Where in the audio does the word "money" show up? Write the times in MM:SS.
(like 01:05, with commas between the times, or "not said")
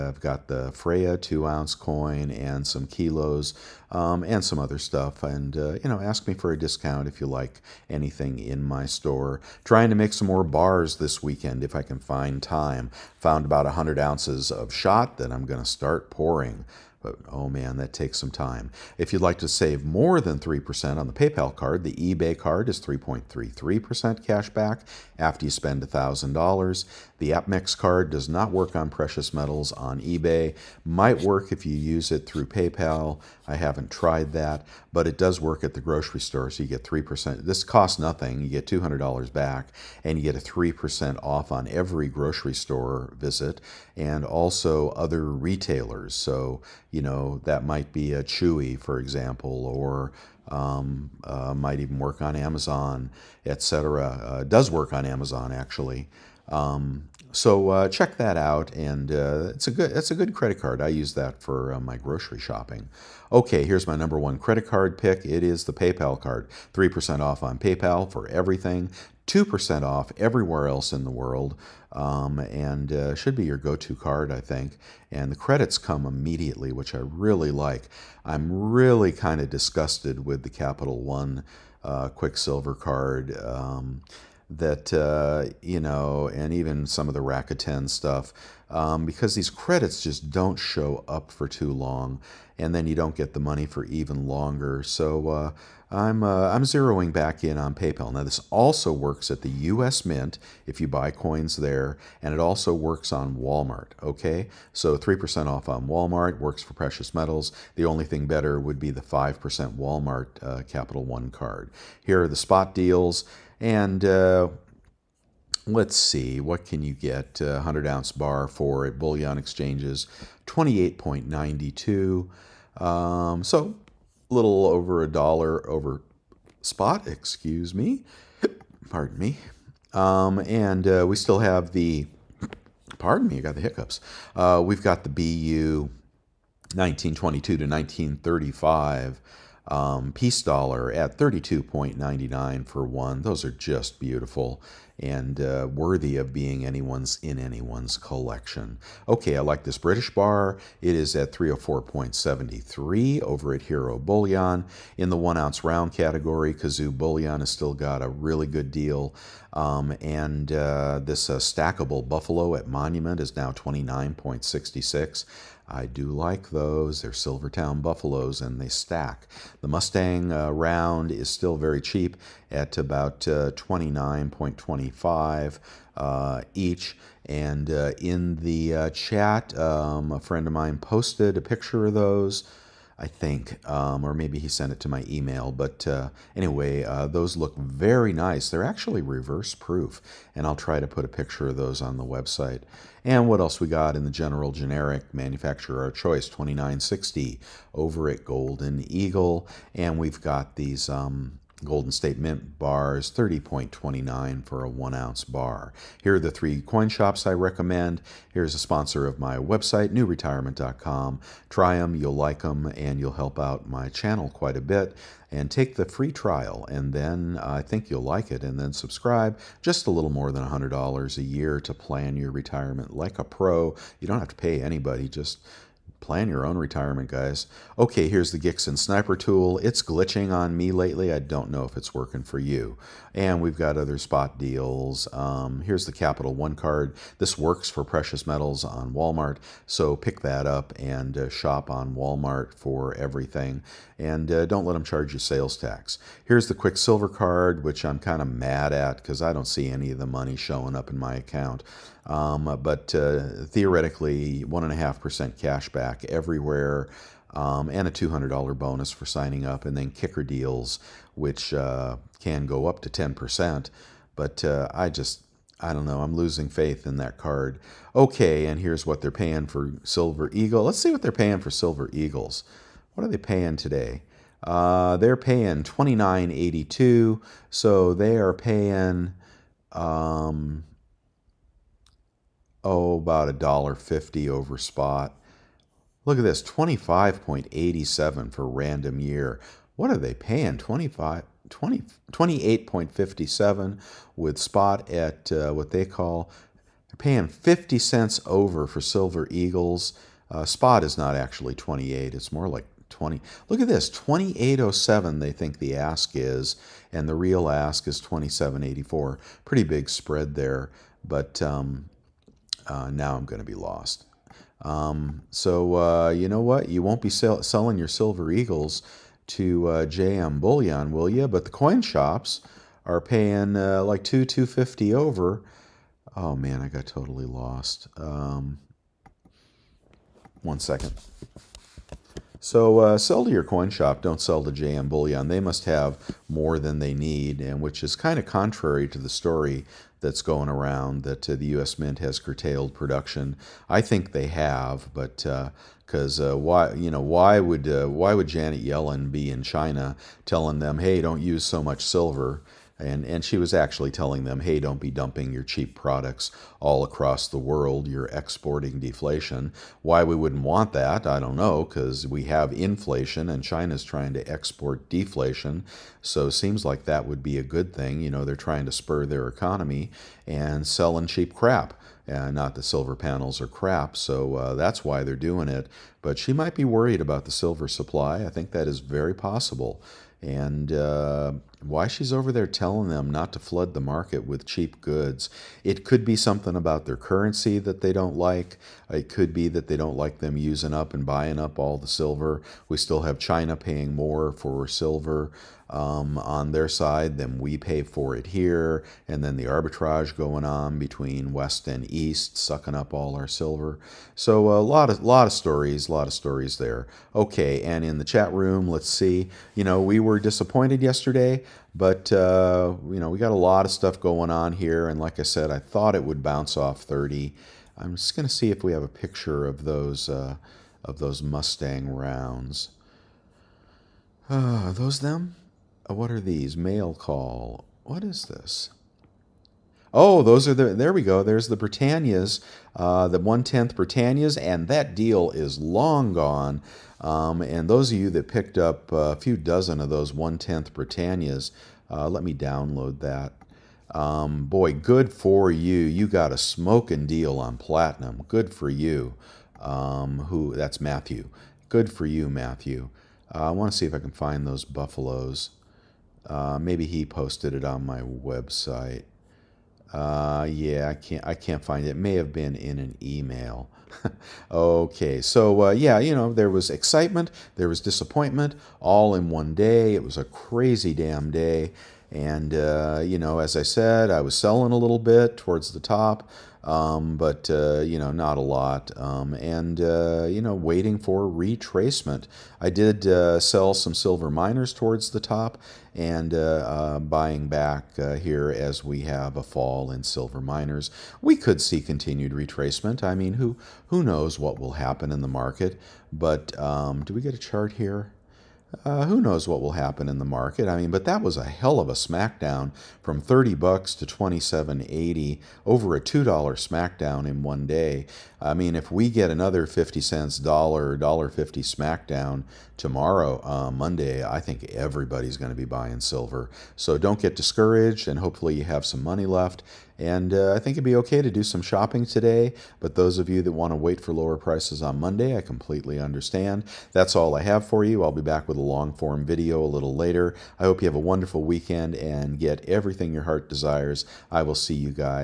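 01:33, 04:10, 08:39.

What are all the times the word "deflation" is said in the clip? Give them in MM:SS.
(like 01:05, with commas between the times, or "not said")
05:58, 06:04.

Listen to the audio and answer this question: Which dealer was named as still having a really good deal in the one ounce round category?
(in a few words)
Kazoo Bullion.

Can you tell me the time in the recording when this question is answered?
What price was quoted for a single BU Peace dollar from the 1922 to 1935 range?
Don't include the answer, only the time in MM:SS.
02:21.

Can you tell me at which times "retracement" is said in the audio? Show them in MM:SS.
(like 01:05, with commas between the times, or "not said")
08:01, 08:12.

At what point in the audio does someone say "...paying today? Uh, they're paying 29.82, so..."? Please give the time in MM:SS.
04:33.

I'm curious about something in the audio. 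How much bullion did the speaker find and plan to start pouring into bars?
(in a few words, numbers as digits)
100 ounces of shot.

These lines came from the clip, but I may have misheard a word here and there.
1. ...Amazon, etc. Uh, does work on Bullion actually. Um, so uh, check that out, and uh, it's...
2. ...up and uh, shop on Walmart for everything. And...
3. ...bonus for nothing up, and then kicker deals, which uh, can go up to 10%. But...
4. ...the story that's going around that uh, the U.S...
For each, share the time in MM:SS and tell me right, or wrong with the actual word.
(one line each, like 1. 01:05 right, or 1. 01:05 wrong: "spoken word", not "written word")
1. 00:52 wrong: "Amazon", not "Bullion"
2. 04:00 right
3. 04:18 wrong: "signing", not "nothing"
4. 05:38 right.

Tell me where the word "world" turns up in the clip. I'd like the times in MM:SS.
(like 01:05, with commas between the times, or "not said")
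01:11, 05:57.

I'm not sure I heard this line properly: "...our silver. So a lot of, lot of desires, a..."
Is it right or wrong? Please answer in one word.
wrong.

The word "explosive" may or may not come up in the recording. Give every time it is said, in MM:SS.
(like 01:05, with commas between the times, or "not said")
not said.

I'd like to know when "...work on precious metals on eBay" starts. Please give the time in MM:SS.
00:28.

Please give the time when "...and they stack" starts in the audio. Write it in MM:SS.
02:48.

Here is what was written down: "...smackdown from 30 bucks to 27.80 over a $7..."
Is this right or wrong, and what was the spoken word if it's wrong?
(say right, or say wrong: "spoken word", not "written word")
wrong: "2", not "7".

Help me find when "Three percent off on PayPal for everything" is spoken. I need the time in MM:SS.
01:06.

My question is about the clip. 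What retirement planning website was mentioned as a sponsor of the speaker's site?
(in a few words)
newretirement.com.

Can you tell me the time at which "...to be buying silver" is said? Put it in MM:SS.
08:35.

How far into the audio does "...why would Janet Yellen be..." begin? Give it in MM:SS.
05:47.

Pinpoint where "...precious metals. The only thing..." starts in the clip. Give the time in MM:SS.
01:46.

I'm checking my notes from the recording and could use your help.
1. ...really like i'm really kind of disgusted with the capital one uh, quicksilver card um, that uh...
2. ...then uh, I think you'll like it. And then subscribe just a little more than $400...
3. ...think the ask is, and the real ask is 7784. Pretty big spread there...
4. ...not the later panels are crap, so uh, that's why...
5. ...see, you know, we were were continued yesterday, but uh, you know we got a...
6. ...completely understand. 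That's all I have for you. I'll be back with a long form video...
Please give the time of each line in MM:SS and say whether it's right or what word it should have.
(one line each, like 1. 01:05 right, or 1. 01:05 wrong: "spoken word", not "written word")
1. 01:16 right
2. 03:36 wrong: "100", not "400"
3. 05:05 wrong: "2784", not "7784"
4. 06:12 wrong: "silver", not "later"
5. 06:48 wrong: "disappointed", not "continued"
6. 08:45 right.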